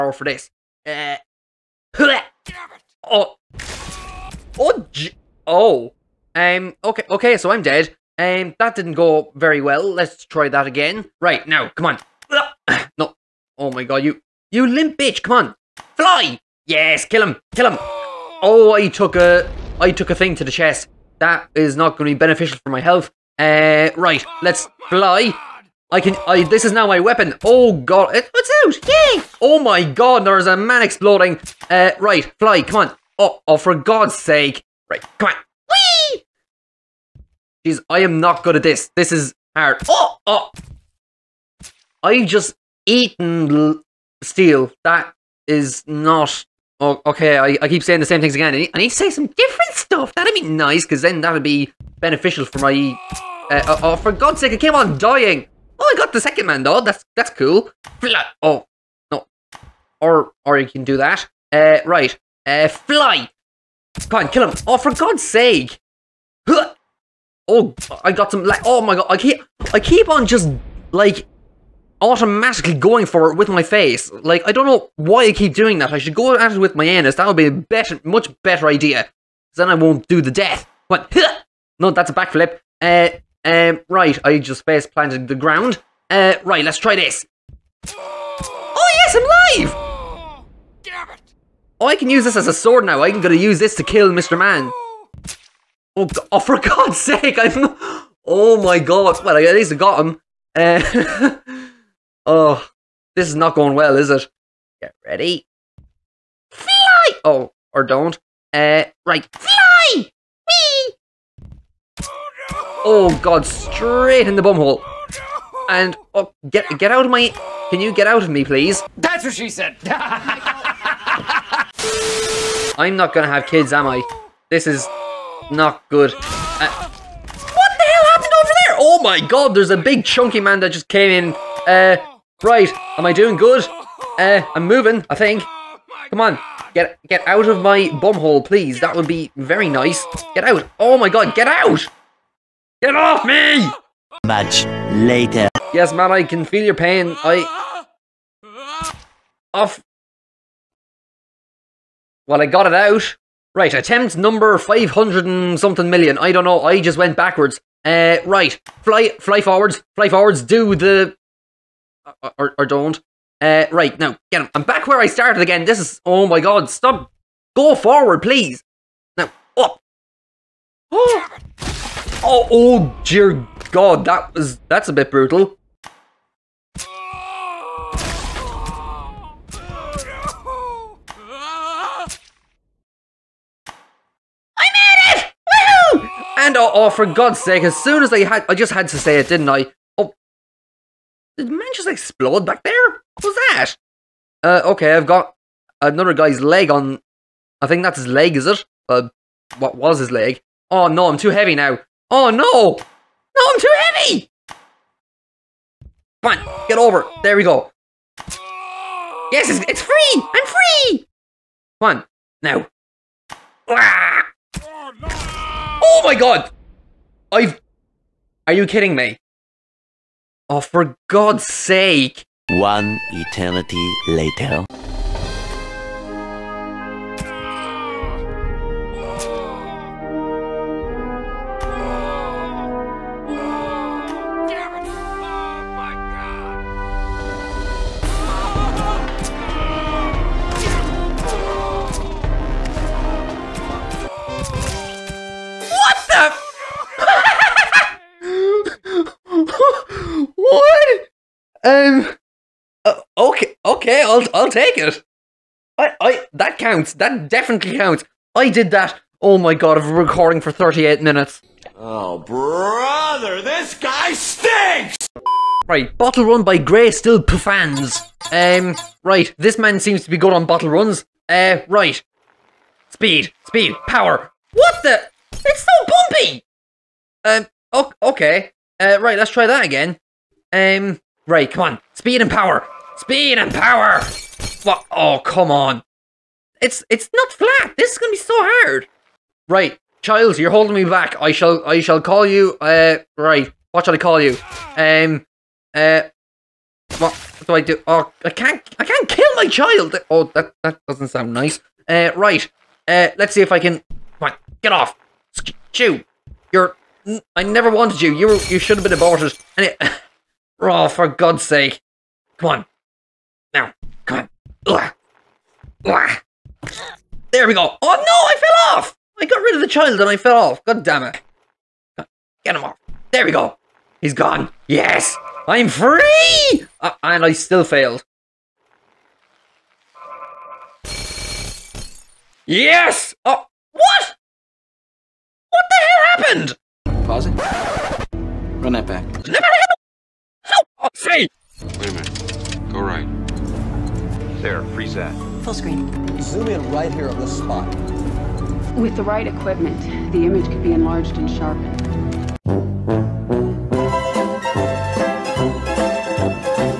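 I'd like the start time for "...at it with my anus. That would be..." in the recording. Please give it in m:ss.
1:16.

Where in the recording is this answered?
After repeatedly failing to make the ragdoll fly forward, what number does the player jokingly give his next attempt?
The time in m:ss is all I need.
2:34.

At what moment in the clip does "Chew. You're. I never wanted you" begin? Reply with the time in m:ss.
5:05.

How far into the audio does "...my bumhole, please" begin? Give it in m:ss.
2:17.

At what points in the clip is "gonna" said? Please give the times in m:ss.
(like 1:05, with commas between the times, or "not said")
1:33, 2:03, 4:47.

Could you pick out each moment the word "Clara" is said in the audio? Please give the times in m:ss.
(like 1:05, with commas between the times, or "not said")
not said.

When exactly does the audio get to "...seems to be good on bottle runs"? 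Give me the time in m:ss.
4:29.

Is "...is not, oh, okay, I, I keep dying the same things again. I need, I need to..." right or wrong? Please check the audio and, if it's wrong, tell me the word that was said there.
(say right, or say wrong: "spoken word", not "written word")
wrong: "saying", not "dying".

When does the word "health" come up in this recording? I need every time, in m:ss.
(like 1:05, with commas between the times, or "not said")
0:22.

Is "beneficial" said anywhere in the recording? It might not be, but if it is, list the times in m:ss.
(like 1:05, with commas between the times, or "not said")
0:22, 0:51.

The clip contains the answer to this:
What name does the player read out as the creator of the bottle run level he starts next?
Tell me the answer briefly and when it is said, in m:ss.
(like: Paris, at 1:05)
Grey Still Puffans, at 4:26.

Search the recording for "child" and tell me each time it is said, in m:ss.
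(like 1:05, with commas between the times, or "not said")
4:50, 4:59, 5:19.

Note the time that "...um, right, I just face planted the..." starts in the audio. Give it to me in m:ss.
1:23.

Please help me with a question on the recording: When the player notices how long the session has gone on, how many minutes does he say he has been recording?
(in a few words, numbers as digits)
38.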